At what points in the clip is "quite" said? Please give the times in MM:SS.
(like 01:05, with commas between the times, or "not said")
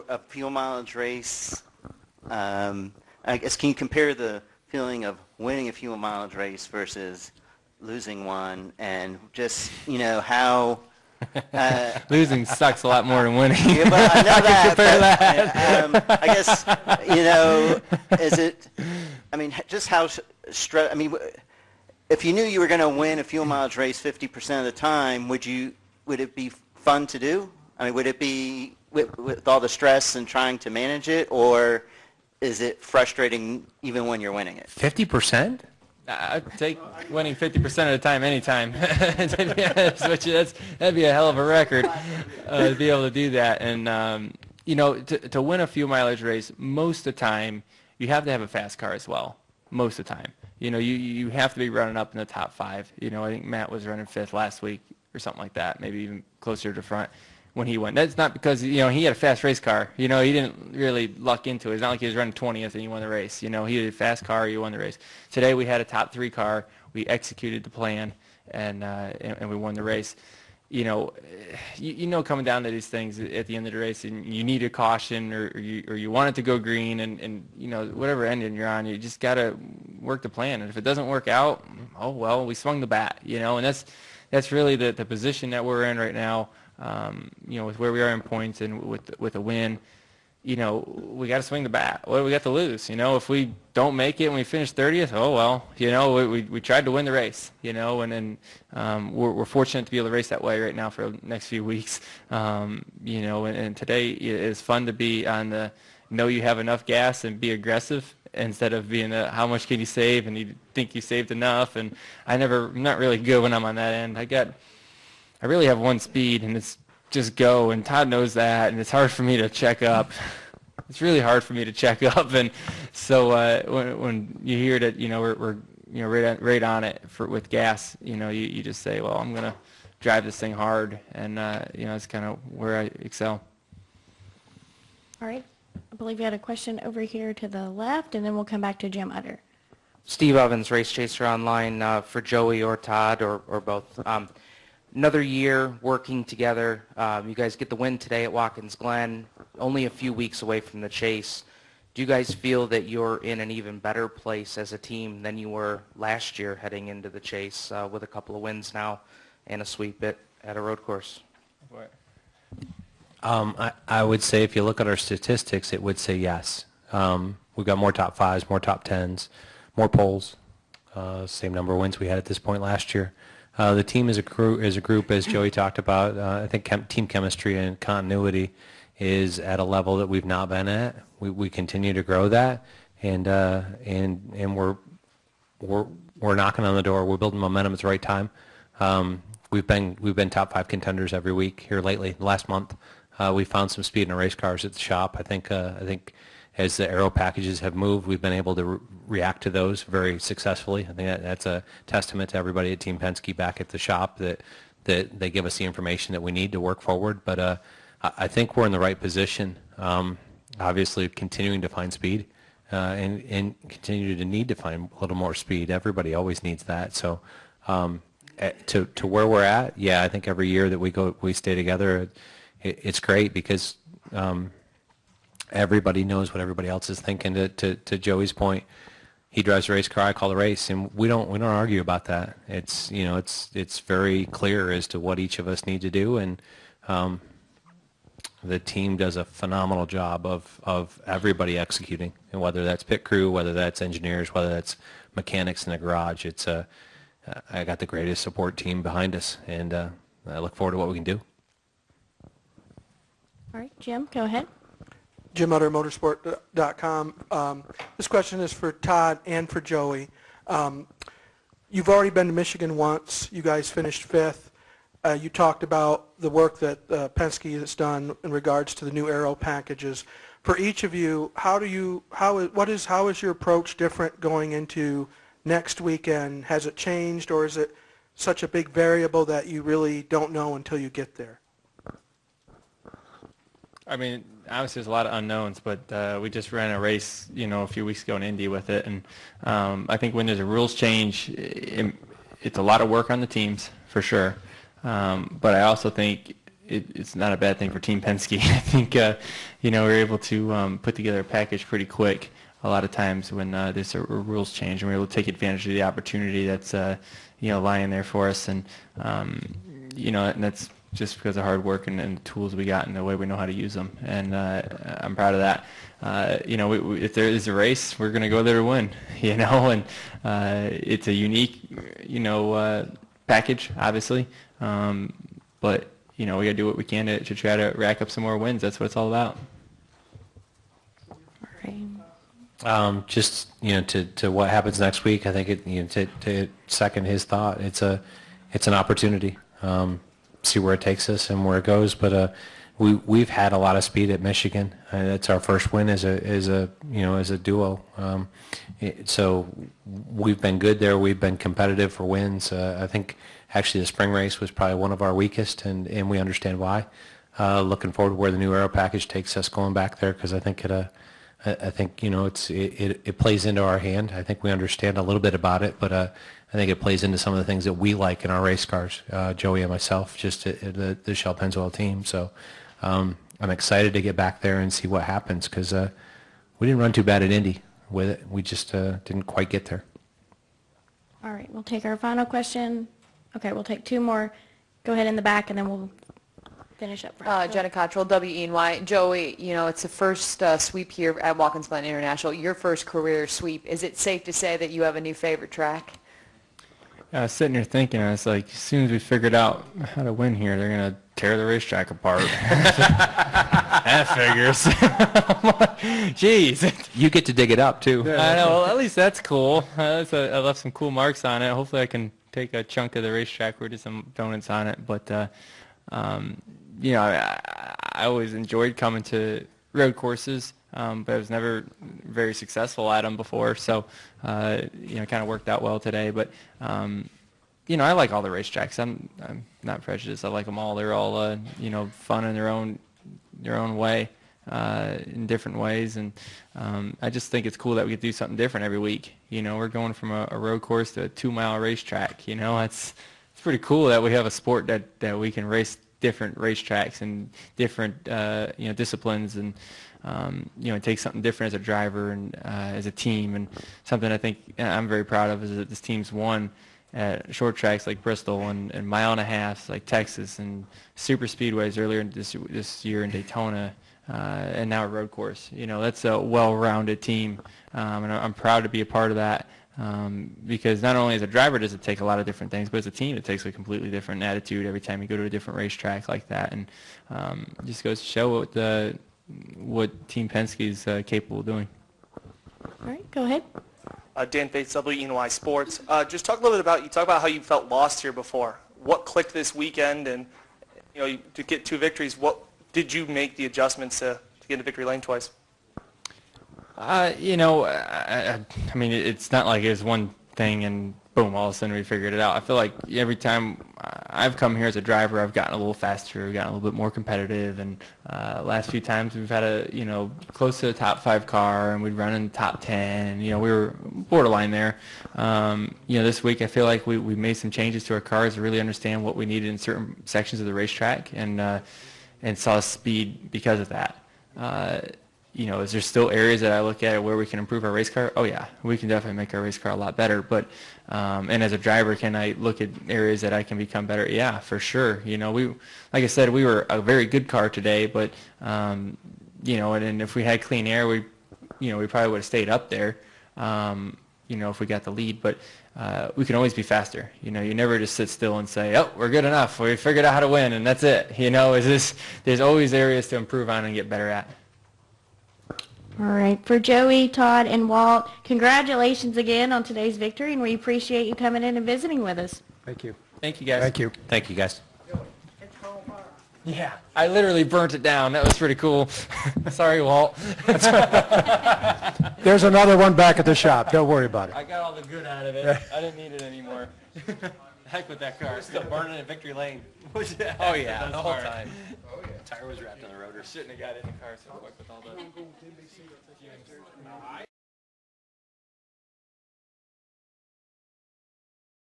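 06:19.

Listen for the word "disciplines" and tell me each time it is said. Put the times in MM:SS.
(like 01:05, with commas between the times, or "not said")
07:28.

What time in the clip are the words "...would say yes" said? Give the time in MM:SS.
02:45.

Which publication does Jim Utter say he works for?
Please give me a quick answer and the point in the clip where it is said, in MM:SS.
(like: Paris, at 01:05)
motorsport.com, at 04:15.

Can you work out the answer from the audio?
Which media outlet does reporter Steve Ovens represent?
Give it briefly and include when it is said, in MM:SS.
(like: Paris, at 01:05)
Race Chaser Online, at 02:20.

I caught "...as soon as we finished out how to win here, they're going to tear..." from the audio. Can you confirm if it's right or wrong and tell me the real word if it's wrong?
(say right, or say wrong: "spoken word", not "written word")
wrong: "figured", not "finished".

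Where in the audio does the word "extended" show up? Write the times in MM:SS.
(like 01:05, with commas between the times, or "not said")
not said.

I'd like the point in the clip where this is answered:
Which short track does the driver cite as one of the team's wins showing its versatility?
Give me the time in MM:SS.
07:38.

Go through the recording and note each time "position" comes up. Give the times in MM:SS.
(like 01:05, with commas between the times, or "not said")
01:25, 03:28.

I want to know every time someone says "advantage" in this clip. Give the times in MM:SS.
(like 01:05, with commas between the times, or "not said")
05:05.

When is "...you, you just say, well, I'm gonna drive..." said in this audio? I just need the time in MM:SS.
02:08.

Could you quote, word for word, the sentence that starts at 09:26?
Yeah, I literally burnt it down.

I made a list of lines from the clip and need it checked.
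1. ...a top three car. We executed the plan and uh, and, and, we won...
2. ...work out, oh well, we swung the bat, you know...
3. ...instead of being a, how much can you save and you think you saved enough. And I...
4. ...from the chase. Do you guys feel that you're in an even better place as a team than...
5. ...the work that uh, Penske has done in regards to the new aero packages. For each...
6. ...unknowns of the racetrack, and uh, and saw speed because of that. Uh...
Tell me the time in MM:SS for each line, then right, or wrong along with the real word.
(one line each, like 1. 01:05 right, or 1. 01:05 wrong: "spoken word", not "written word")
1. 01:05 right
2. 01:21 right
3. 01:48 right
4. 02:30 right
5. 04:26 right
6. 08:40 wrong: "sections", not "unknowns".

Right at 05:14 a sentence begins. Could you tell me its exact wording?
And uh, I'm proud of that.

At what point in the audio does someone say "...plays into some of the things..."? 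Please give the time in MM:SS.
06:06.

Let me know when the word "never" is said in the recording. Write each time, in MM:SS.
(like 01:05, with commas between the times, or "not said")
01:52, 07:01, 09:07.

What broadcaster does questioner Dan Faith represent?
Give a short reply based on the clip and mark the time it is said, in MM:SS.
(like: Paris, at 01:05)
WNY Sports, at 08:04.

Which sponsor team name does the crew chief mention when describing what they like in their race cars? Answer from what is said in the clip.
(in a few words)
Shell Pennzoil.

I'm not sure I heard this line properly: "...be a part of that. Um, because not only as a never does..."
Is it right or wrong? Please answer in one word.
wrong.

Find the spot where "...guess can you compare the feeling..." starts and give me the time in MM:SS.
00:03.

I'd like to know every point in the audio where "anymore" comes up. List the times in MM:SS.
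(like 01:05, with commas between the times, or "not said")
09:36.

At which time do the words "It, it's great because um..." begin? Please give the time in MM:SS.
03:42.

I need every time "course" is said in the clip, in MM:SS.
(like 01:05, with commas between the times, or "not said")
02:40, 06:59, 07:20, 07:45.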